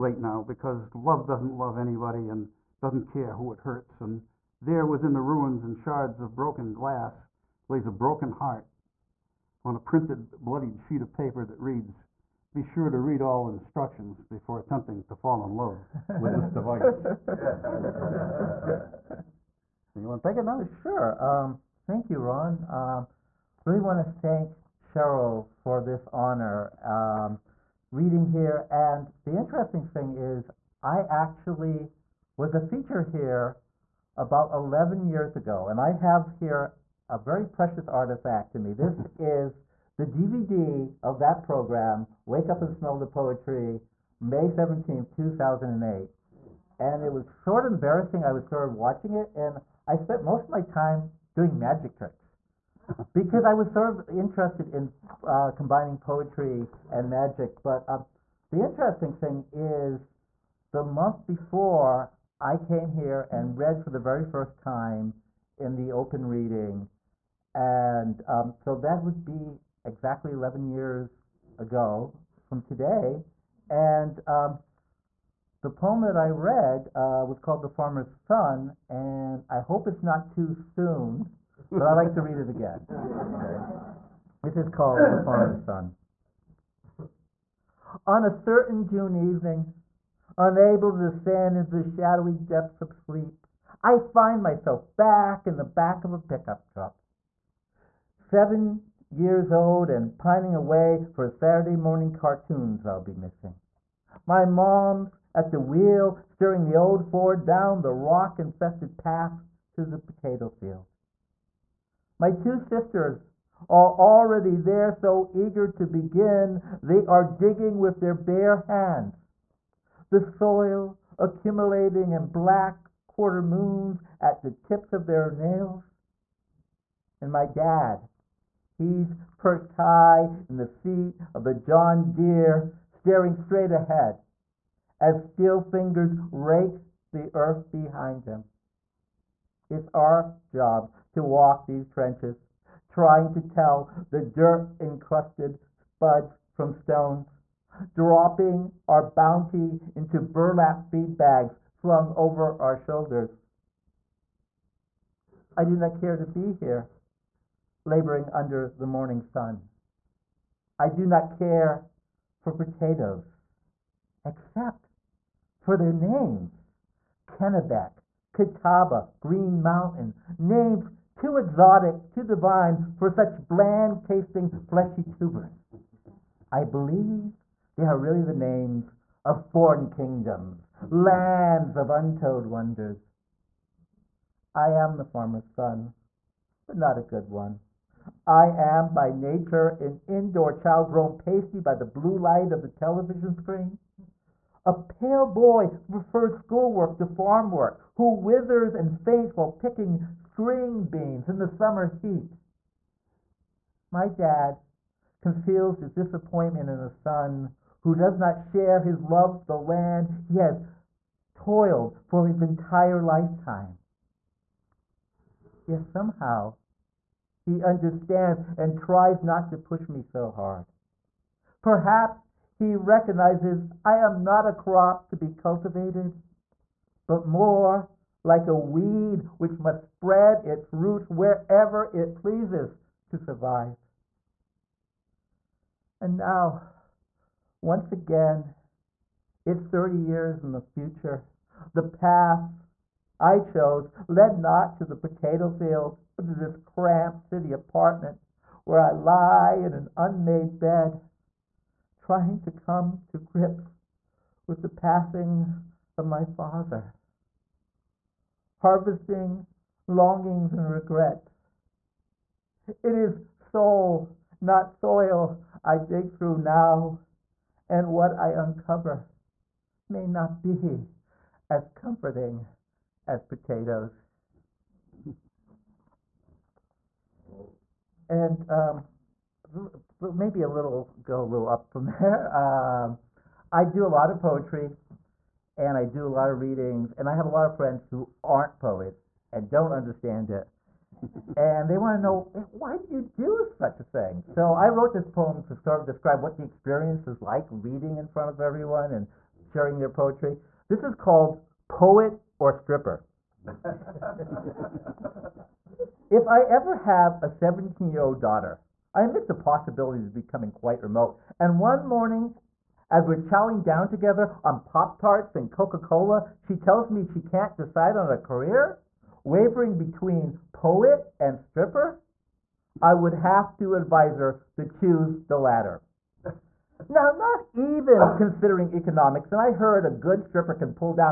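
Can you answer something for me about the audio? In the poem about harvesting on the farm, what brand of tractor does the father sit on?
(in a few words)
John Deere.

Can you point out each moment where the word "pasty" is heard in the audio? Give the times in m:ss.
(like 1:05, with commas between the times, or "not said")
3:11.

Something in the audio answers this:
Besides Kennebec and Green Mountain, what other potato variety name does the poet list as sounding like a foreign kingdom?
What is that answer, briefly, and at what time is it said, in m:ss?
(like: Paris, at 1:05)
Catawba, at 2:48.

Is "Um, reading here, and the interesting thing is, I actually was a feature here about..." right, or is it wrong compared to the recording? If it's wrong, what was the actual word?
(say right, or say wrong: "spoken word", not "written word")
right.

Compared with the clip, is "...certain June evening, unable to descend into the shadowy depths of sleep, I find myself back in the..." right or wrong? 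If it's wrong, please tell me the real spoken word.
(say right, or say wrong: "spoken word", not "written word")
right.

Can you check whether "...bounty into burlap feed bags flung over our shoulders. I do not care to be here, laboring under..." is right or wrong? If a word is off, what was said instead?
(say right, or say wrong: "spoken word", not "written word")
right.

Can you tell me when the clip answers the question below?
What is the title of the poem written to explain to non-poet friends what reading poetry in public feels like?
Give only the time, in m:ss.
5:01.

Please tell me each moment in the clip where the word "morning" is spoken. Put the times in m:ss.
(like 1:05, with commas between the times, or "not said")
1:41, 2:38, 5:11.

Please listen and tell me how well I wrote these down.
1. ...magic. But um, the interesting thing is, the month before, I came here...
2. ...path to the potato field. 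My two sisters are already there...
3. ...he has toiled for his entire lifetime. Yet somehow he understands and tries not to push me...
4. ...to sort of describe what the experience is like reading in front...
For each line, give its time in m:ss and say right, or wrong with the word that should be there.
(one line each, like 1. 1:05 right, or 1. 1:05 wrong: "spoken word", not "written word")
1. 0:57 right
2. 1:48 right
3. 3:30 right
4. 4:55 right.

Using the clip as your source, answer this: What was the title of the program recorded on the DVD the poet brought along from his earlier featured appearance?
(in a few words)
Wake Up and Smell the Poetry.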